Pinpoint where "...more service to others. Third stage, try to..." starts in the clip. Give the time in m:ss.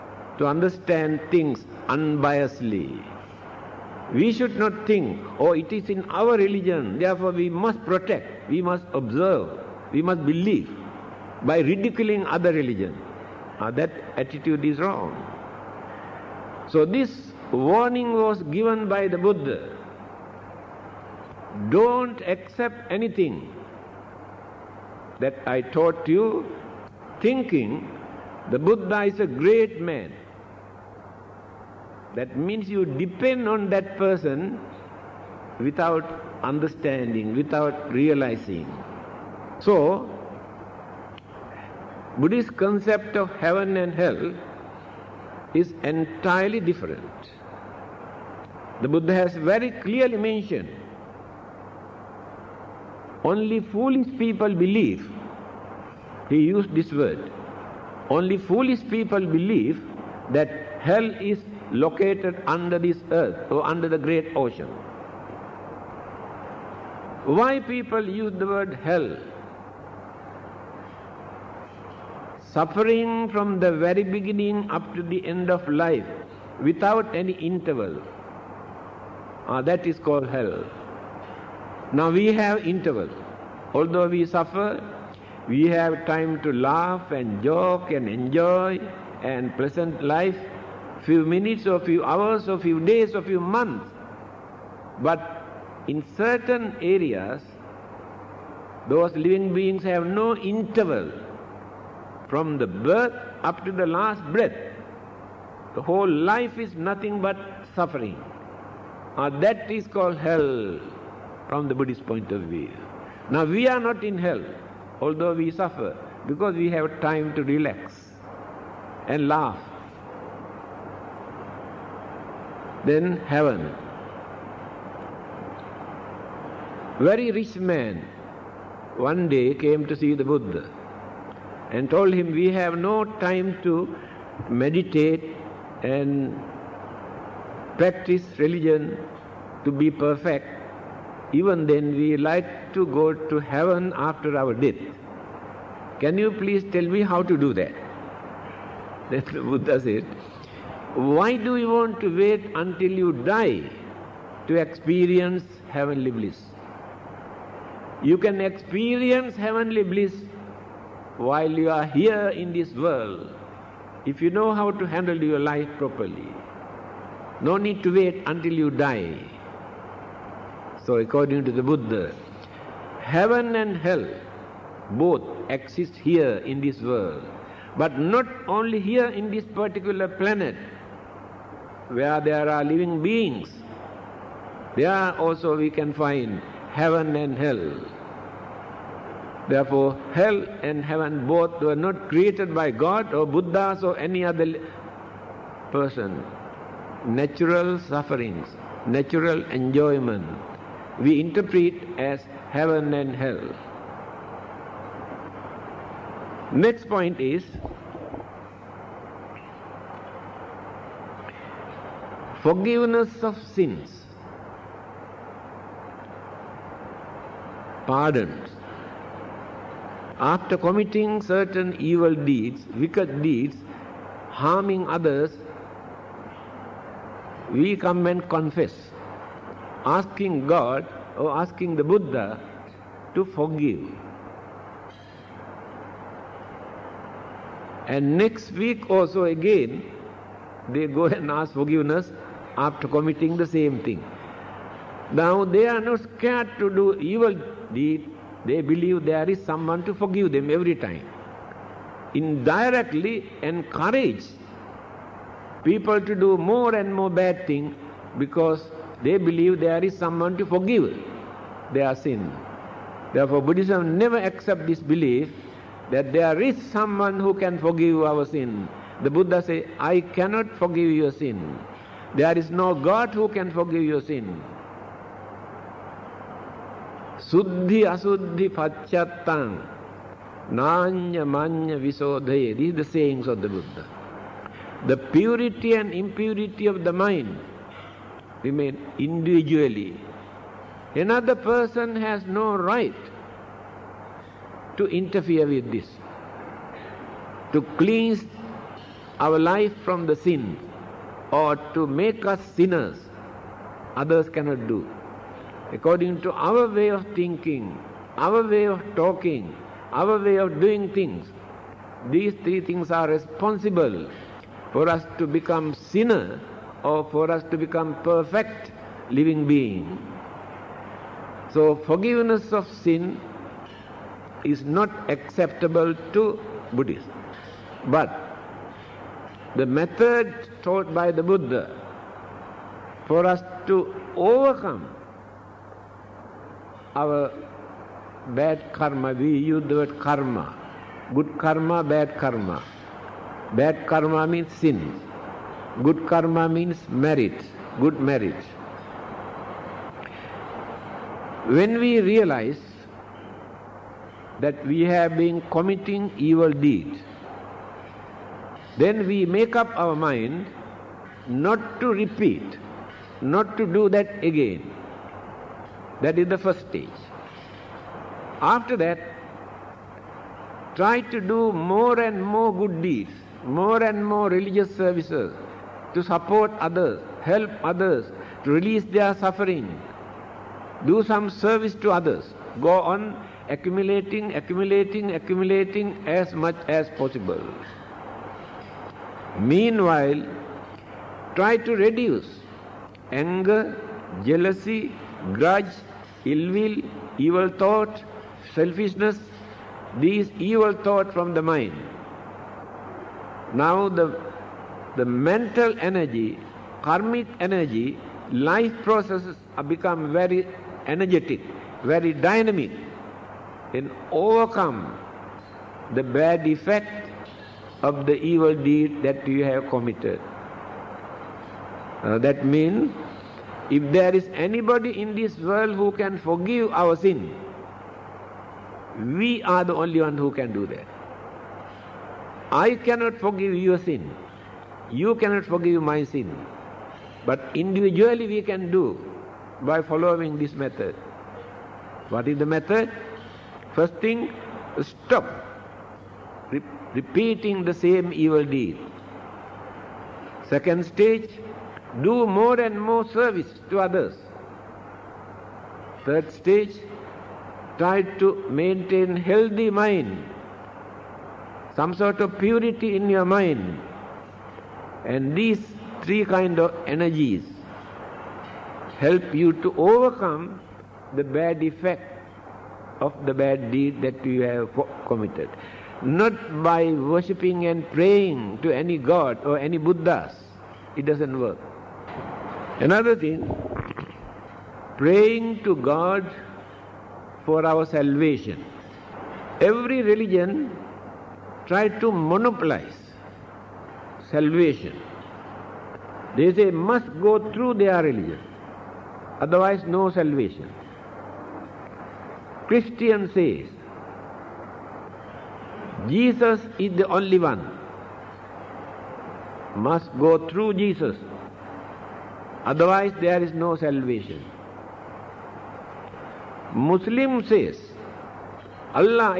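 7:32.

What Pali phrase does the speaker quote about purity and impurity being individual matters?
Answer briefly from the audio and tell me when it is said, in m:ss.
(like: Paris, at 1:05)
Suddhi asuddhi pachattang, at 4:37.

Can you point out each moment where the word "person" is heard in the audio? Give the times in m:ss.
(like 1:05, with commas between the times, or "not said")
0:33, 3:15, 4:51.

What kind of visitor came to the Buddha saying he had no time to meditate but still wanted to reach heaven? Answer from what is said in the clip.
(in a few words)
very rich man.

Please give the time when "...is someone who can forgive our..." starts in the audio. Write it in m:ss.
4:26.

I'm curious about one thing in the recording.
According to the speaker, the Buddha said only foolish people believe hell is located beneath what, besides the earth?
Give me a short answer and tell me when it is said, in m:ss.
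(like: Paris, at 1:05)
the great ocean, at 1:03.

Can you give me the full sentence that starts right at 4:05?
Now they are not scared to do evil deed.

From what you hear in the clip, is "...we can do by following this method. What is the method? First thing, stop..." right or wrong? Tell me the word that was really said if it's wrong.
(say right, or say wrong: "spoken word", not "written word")
right.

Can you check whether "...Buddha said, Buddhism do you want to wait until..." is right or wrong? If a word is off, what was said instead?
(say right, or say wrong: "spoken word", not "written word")
wrong: "Why", not "Buddhism".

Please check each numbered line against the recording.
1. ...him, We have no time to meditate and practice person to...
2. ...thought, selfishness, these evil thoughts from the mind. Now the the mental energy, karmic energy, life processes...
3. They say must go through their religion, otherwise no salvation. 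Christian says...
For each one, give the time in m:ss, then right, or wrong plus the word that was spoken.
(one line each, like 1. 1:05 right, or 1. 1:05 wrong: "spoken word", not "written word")
1. 2:12 wrong: "religion", not "person"
2. 6:37 right
3. 8:16 right.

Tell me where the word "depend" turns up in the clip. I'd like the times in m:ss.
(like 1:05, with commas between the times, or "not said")
0:32.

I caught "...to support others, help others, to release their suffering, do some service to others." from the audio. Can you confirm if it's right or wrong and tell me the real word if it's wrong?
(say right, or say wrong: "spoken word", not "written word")
right.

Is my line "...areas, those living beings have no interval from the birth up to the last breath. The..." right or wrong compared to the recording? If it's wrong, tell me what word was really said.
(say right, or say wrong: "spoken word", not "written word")
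right.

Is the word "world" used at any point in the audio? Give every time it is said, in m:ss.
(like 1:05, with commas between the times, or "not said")
2:42, 2:56, 7:05.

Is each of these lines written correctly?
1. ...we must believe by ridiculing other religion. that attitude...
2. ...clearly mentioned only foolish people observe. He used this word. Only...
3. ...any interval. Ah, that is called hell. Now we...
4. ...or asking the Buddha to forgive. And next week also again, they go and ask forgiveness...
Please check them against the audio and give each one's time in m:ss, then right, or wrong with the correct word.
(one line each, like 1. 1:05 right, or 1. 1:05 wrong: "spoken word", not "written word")
1. 0:09 right
2. 0:49 wrong: "believe", not "observe"
3. 1:17 right
4. 3:51 right.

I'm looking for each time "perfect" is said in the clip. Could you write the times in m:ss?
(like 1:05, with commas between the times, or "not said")
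2:19, 5:18.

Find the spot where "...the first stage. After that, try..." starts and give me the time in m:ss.
6:06.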